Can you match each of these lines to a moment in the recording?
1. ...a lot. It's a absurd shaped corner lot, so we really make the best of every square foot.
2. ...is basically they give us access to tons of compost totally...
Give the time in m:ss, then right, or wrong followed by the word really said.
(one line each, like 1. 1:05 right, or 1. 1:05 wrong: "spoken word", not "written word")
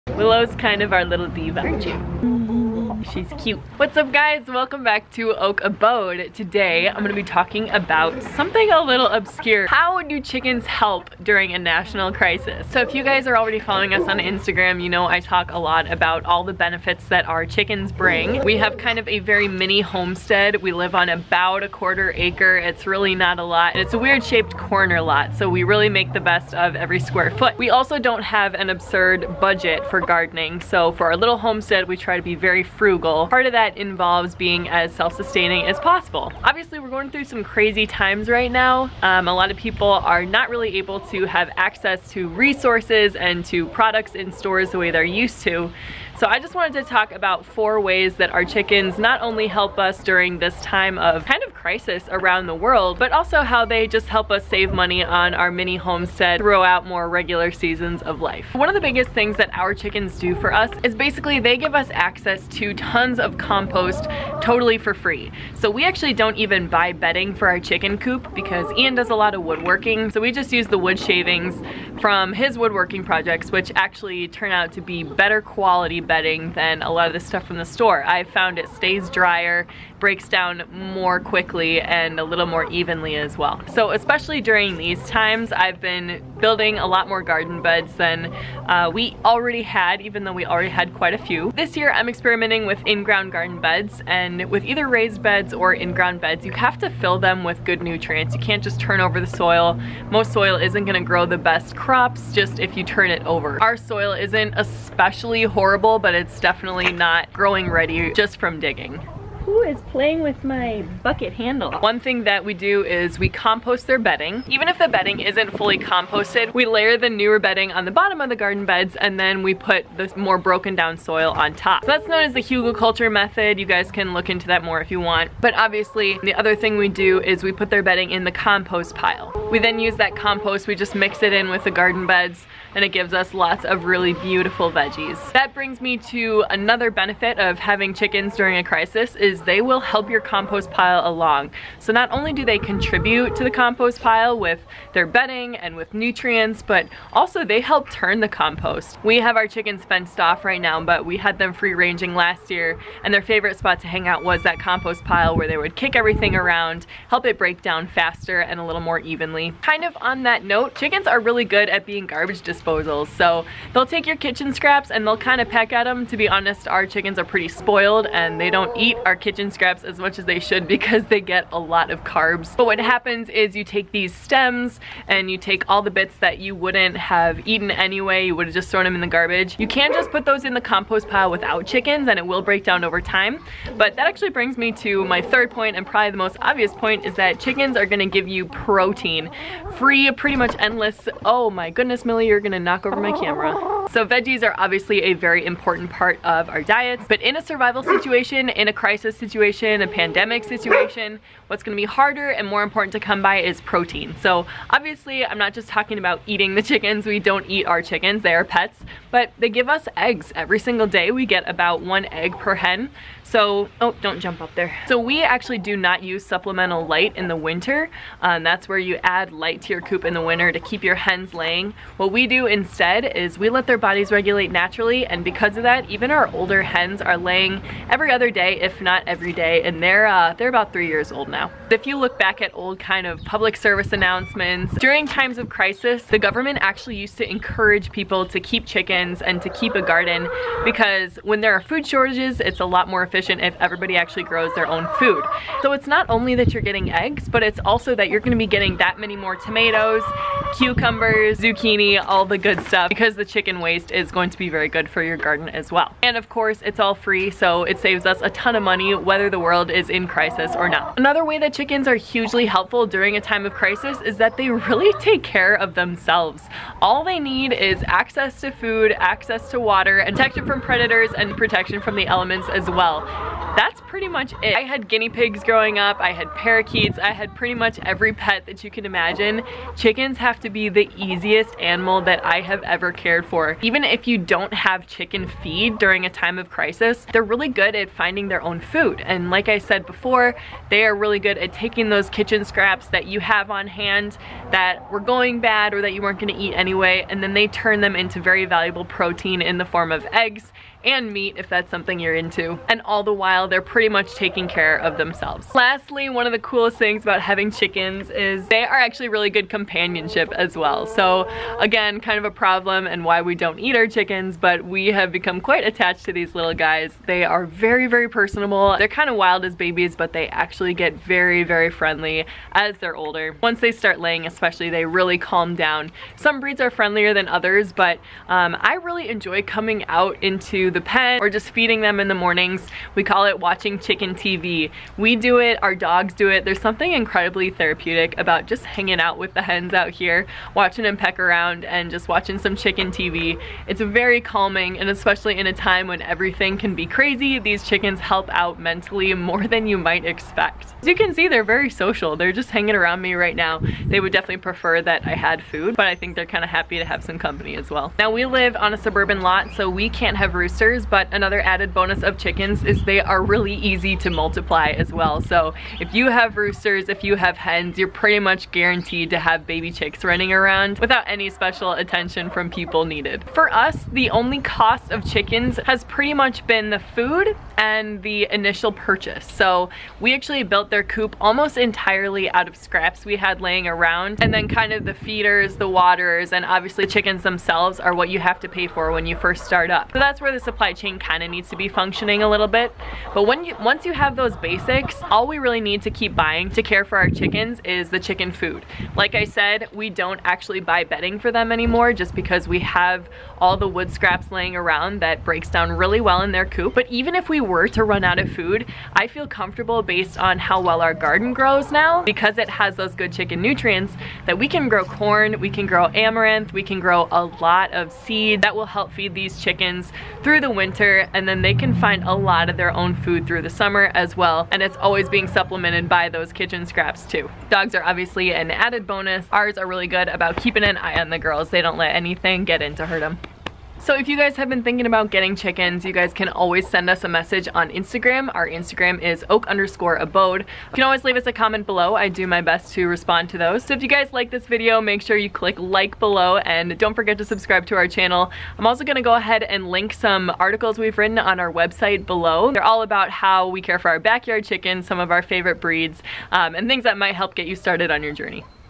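1. 0:23 wrong: "weird", not "absurd"
2. 1:00 right.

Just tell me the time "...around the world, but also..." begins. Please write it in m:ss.
0:52.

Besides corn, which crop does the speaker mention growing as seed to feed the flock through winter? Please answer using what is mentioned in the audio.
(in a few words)
amaranth.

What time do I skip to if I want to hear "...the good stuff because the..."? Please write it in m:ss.
4:12.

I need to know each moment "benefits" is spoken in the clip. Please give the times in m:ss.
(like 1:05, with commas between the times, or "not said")
0:16, 2:16.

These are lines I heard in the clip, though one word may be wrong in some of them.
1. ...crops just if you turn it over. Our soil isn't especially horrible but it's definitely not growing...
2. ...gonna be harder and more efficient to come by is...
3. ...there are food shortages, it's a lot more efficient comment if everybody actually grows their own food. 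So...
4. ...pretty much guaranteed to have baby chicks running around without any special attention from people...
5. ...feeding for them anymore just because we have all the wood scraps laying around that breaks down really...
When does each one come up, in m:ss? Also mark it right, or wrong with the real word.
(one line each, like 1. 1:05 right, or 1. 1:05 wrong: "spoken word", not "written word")
1. 1:41 right
2. 3:21 wrong: "important", not "efficient"
3. 4:01 wrong: "efficient", not "comment"
4. 6:07 right
5. 6:40 wrong: "bedding", not "feeding".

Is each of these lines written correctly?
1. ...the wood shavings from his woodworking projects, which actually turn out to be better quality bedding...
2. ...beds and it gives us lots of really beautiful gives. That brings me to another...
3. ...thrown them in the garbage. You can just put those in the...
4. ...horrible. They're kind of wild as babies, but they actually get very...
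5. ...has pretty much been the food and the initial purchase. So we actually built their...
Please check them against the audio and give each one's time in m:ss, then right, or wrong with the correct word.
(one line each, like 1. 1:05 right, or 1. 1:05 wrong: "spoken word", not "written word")
1. 1:10 right
2. 2:12 wrong: "veggies", not "gives"
3. 2:58 right
4. 5:18 wrong: "personable", not "horrible"
5. 6:15 right.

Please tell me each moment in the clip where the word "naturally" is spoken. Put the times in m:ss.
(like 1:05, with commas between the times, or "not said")
3:44.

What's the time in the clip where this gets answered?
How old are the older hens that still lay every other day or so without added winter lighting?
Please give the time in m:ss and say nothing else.
3:50.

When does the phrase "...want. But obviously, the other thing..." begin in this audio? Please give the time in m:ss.
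2:04.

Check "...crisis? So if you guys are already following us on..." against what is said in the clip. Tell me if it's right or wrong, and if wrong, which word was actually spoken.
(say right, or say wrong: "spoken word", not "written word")
right.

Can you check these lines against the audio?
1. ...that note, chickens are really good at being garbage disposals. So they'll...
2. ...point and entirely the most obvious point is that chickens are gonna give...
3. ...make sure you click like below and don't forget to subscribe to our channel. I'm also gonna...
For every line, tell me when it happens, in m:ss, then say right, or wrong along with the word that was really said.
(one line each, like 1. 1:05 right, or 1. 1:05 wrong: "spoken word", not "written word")
1. 2:40 right
2. 3:05 wrong: "probably", not "entirely"
3. 7:24 right.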